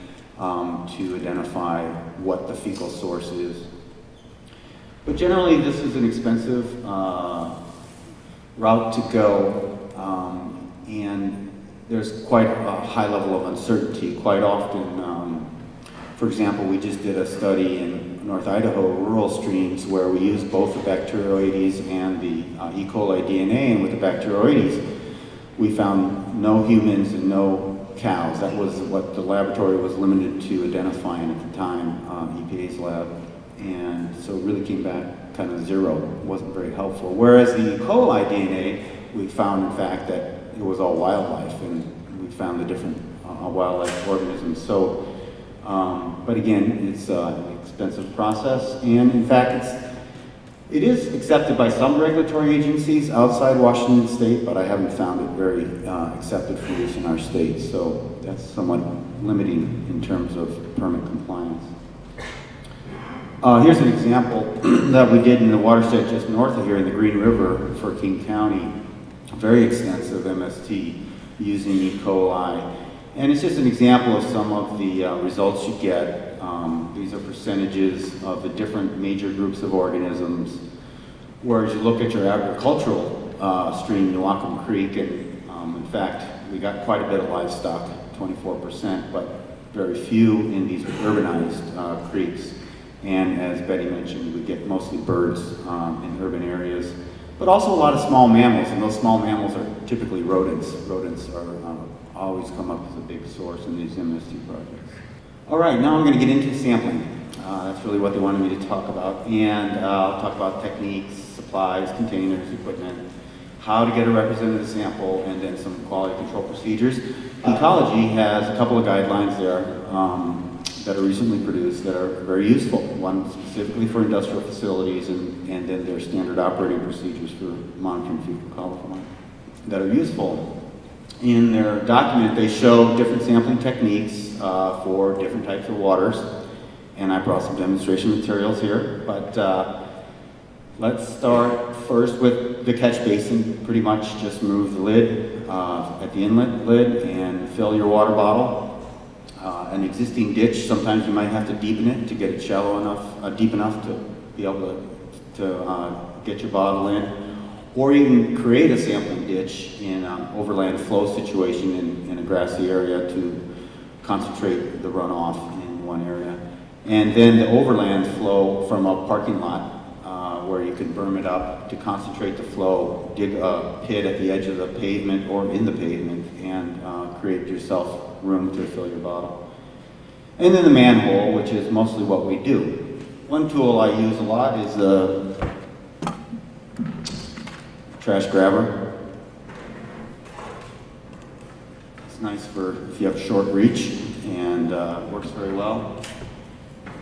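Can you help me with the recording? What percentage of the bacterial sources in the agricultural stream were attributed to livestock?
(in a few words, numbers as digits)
24%.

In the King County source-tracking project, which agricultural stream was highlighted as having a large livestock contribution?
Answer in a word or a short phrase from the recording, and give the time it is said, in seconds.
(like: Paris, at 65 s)
Newaukum Creek, at 84 s.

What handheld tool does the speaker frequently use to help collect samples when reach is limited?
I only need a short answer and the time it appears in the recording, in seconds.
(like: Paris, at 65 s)
trash grabber, at 188 s.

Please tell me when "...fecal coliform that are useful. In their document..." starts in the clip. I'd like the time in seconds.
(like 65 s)
128 s.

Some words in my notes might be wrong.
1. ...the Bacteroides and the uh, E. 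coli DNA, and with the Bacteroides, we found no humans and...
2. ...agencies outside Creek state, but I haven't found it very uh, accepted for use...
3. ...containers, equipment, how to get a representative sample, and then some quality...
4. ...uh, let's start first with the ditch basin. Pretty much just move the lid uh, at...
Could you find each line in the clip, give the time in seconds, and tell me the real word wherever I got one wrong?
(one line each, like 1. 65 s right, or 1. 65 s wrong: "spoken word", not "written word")
1. 20 s right
2. 52 s wrong: "Washington", not "Creek"
3. 111 s right
4. 139 s wrong: "catch", not "ditch".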